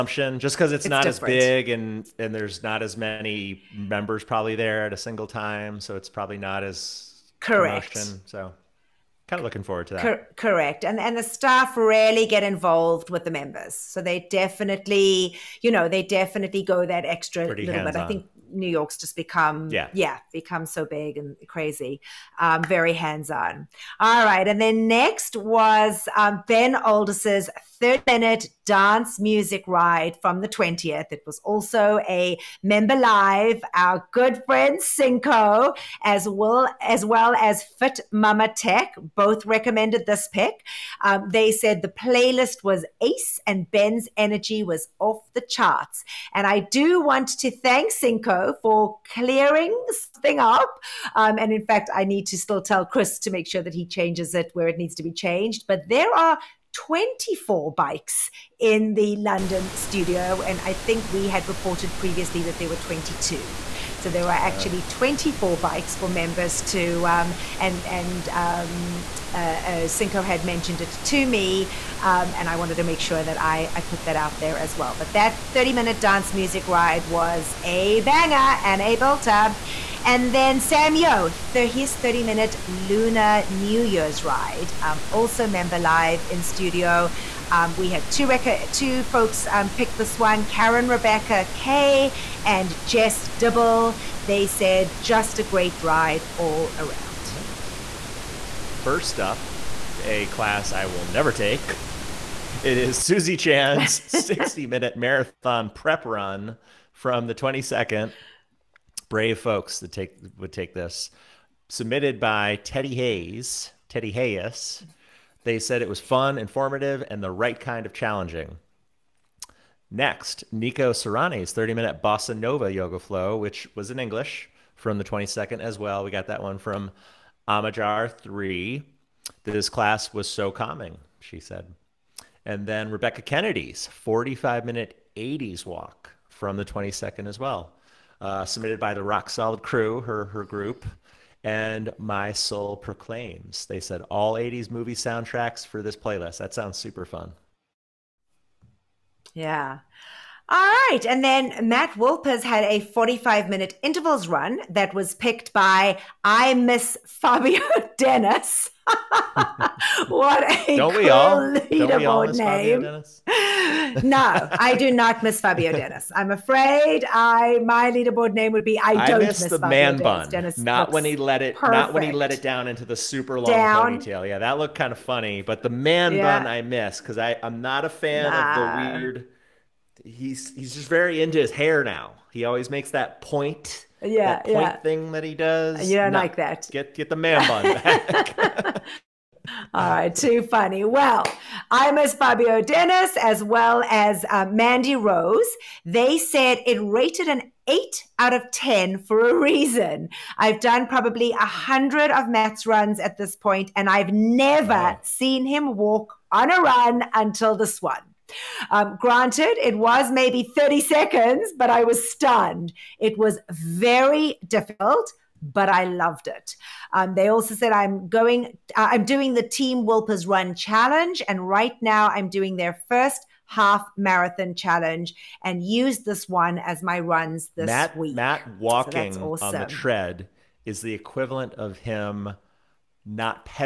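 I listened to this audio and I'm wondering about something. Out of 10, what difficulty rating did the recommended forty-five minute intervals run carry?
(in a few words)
8.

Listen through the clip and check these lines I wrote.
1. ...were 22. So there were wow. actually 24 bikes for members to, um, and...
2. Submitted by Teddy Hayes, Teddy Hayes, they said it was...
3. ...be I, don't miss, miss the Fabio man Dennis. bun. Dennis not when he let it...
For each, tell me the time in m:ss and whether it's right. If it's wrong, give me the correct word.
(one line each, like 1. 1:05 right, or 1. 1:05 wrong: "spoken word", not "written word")
1. 1:02 right
2. 1:51 right
3. 2:48 right.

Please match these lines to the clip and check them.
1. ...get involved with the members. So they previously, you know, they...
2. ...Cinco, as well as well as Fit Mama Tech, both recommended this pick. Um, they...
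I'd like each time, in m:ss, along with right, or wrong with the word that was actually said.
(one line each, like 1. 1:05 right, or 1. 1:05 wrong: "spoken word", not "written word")
1. 0:12 wrong: "definitely", not "previously"
2. 0:34 right.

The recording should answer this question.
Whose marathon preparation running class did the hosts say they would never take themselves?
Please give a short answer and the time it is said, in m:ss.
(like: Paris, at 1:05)
Susie Chan, at 1:43.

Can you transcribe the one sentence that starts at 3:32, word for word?
It was very difficult but I loved it.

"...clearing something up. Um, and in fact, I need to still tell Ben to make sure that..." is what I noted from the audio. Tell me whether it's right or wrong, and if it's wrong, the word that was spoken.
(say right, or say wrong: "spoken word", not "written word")
wrong: "Chris", not "Ben".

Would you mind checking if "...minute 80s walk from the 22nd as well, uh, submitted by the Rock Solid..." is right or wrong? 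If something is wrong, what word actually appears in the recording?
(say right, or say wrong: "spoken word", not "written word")
right.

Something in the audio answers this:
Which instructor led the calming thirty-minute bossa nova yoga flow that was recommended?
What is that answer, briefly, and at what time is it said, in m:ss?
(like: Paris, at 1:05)
Nico Sarani, at 2:00.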